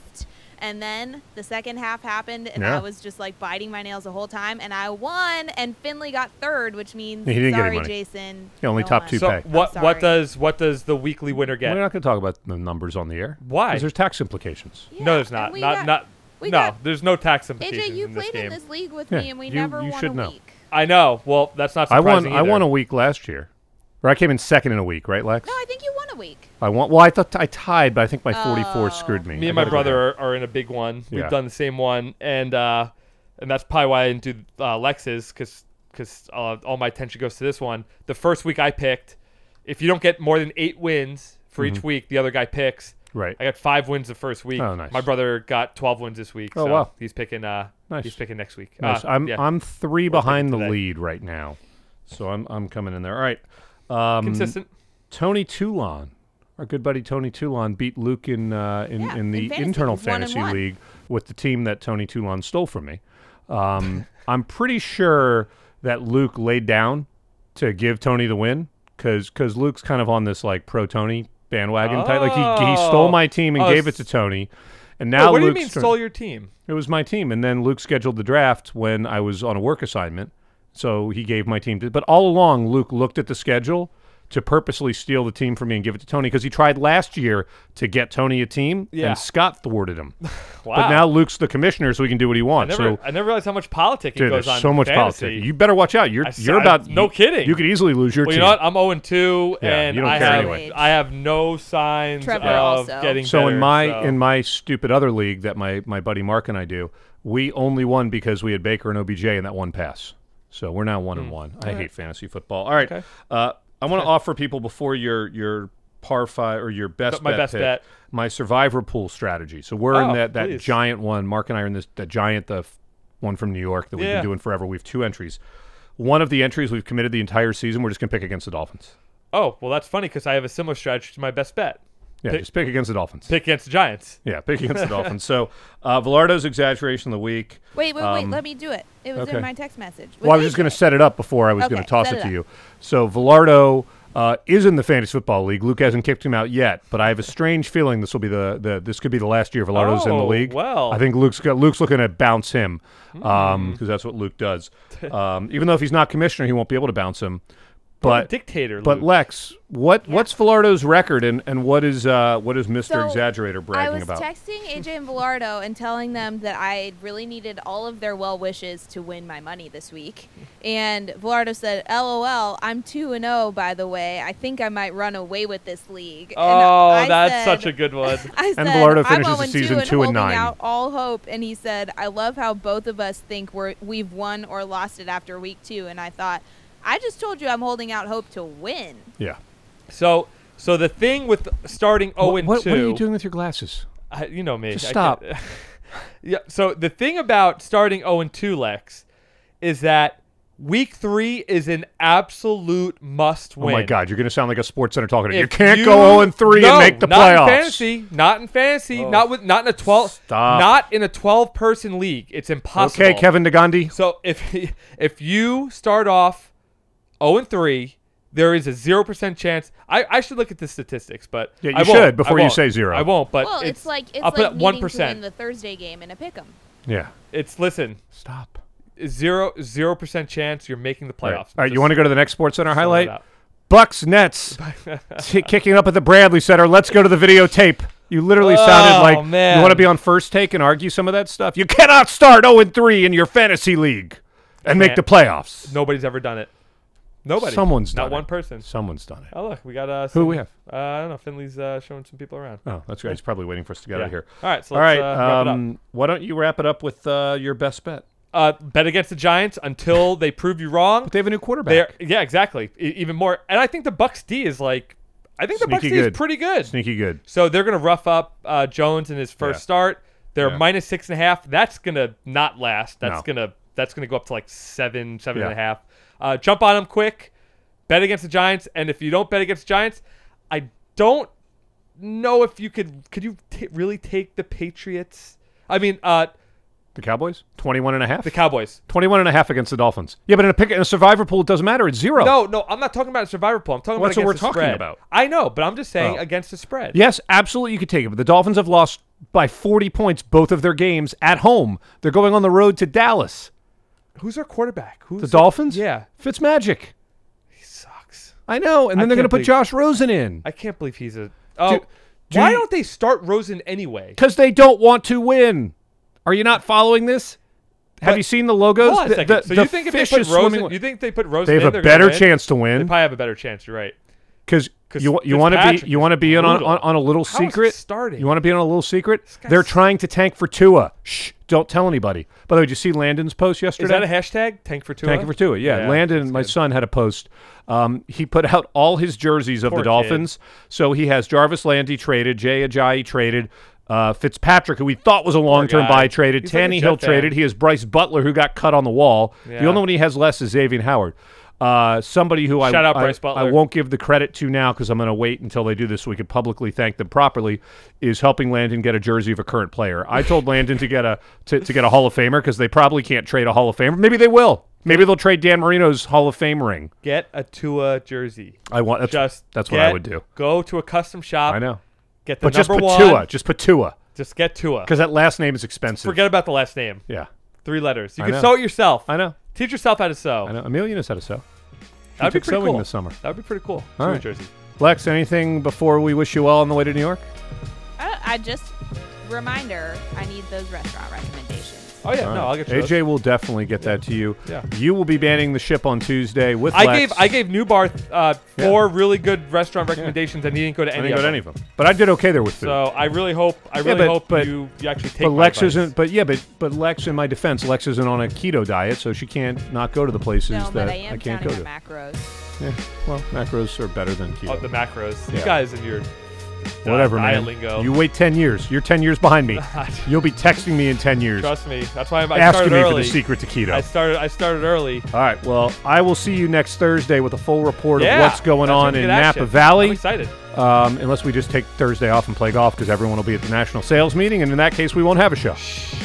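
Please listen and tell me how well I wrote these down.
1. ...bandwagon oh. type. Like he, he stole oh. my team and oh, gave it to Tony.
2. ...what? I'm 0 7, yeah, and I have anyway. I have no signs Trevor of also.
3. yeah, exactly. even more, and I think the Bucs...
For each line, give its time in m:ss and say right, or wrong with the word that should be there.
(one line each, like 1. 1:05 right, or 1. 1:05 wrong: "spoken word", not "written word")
1. 1:11 right
2. 1:38 wrong: "2", not "7"
3. 4:21 right.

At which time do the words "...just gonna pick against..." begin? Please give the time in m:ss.
2:07.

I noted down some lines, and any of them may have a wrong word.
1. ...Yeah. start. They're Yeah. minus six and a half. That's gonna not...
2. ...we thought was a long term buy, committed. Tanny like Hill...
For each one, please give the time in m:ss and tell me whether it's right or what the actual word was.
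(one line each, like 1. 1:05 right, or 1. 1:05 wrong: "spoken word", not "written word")
1. 4:29 right
2. 5:44 wrong: "traded", not "committed".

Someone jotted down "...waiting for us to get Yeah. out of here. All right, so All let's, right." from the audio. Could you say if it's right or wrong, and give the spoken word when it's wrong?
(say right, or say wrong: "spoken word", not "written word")
right.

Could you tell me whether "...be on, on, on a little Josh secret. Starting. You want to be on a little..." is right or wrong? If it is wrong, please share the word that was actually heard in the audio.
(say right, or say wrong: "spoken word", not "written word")
wrong: "How", not "Josh".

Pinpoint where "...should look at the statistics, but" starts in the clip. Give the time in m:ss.
3:40.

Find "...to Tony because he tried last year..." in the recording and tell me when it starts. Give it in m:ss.
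1:25.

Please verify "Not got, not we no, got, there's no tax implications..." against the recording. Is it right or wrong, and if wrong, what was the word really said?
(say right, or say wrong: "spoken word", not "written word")
right.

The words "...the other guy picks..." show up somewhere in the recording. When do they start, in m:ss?
0:42.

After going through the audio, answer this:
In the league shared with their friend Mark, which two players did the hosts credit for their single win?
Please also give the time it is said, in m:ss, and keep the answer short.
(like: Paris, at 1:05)
Baker and OBJ, at 1:48.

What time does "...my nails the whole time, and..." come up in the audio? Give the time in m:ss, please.
0:03.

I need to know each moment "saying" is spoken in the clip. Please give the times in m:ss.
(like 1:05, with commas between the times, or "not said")
4:55.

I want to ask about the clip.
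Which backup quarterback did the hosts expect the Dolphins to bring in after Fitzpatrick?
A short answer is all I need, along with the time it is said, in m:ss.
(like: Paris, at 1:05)
Josh Rosen, at 5:09.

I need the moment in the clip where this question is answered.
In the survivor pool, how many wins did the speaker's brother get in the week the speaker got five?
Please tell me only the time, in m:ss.
0:45.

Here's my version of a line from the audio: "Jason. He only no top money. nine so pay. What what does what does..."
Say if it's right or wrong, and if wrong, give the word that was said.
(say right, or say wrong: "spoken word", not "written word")
wrong: "two", not "nine".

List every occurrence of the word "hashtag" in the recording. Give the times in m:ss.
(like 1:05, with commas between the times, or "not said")
5:34.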